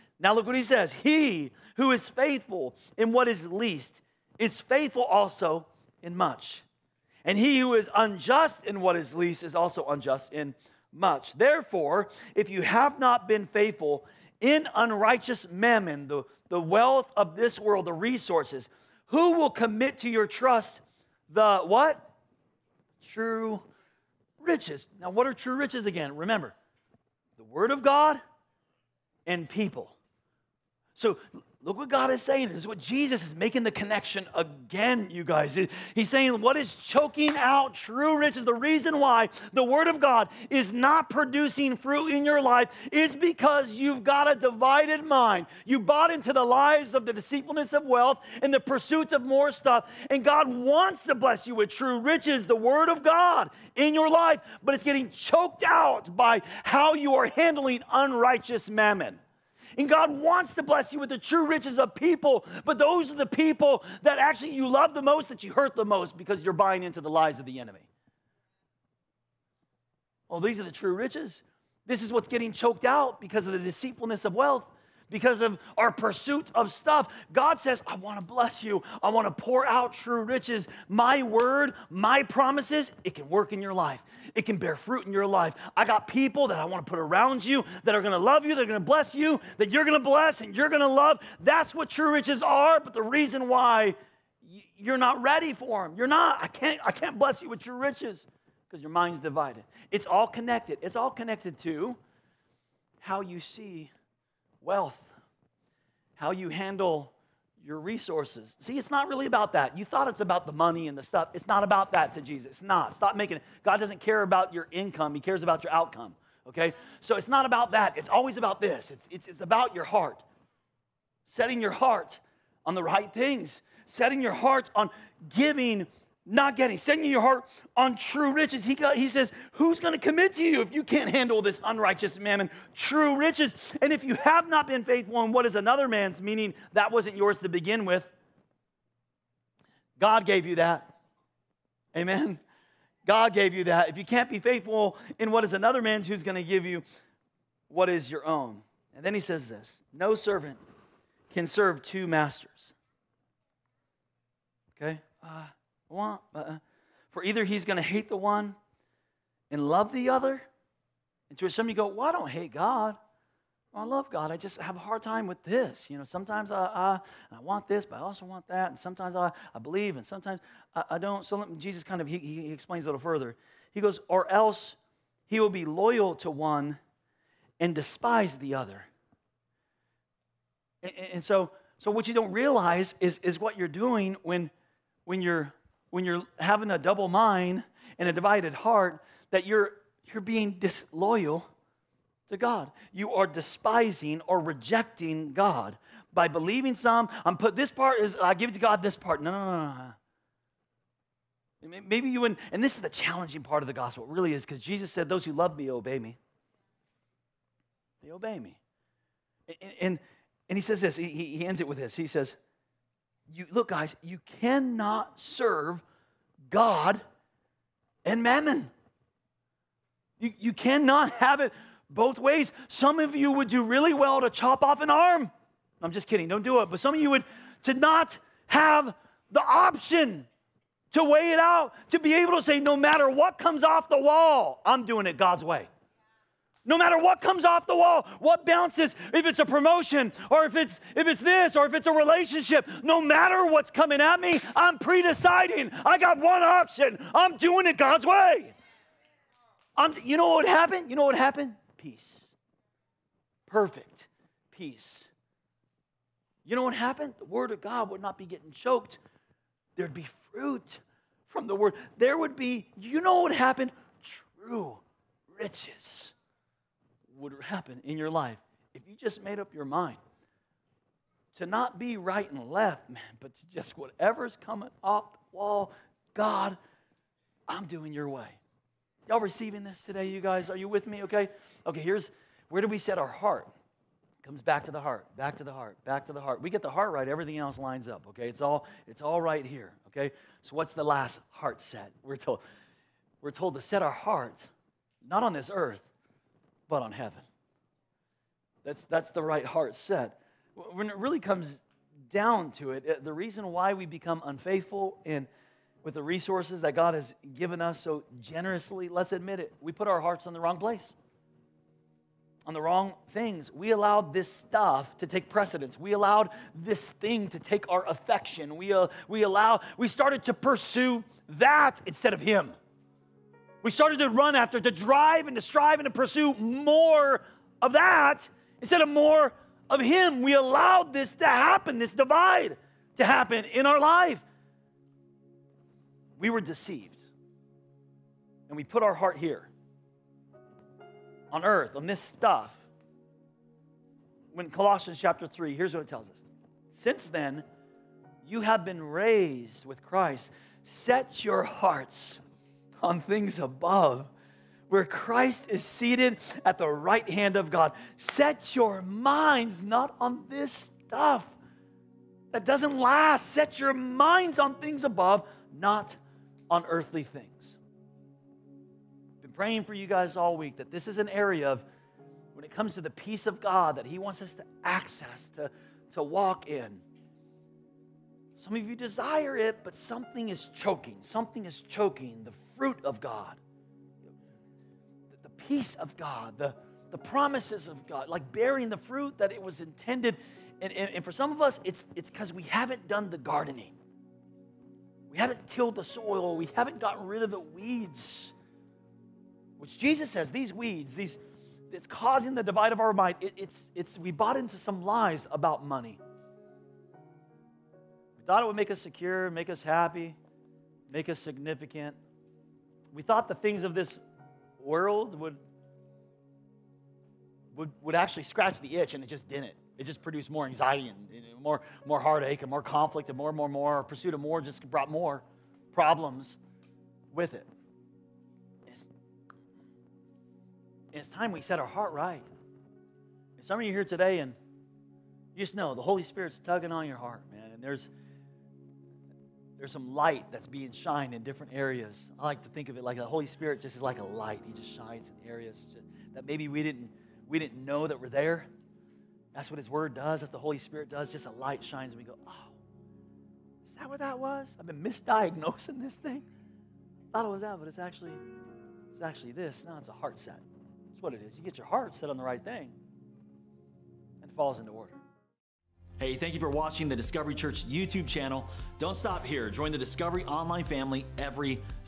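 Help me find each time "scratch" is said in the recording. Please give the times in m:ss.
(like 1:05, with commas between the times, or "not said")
6:58.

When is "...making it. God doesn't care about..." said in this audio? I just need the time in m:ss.
1:53.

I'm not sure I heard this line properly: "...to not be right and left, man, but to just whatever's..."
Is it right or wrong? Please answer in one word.
right.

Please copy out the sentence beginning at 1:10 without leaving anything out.
Well, these are the true riches.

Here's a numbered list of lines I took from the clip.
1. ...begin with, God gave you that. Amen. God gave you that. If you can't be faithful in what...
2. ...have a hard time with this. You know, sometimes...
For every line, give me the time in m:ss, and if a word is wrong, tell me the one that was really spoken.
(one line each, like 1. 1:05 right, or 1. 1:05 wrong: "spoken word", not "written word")
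1. 2:17 right
2. 2:44 right.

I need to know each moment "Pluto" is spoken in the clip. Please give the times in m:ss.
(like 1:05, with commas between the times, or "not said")
not said.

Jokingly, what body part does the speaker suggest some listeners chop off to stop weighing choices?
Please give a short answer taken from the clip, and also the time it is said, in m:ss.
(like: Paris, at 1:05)
An arm, at 3:44.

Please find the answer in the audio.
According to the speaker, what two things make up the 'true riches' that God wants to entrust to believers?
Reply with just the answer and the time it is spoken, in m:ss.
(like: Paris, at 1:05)
The Word of God and people, at 0:27.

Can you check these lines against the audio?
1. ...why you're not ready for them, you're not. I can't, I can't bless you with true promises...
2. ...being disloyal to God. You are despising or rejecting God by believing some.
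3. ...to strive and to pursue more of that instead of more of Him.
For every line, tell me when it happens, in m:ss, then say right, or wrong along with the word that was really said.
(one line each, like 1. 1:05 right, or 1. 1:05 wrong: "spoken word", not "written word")
1. 1:33 wrong: "riches", not "promises"
2. 3:10 right
3. 5:25 right.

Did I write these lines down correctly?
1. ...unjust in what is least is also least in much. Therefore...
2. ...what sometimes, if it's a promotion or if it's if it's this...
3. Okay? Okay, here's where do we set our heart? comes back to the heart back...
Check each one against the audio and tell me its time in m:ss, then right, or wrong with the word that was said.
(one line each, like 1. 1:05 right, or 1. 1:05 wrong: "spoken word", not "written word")
1. 0:07 wrong: "unjust", not "least"
2. 3:58 wrong: "bounces", not "sometimes"
3. 4:41 right.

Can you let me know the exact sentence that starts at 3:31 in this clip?
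He says, you look, guys, you cannot serve God and mammon.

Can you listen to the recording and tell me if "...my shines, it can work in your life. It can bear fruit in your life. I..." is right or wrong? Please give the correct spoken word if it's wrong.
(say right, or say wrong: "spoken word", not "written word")
wrong: "promises", not "shines".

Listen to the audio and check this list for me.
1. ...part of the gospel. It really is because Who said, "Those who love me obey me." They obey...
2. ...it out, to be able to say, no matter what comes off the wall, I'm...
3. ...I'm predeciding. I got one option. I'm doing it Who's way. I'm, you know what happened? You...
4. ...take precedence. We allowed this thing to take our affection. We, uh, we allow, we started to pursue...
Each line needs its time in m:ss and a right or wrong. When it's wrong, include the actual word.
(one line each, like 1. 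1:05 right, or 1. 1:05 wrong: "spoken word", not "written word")
1. 3:23 wrong: "Jesus", not "Who"
2. 3:51 right
3. 4:04 wrong: "God", not "Who"
4. 5:15 right.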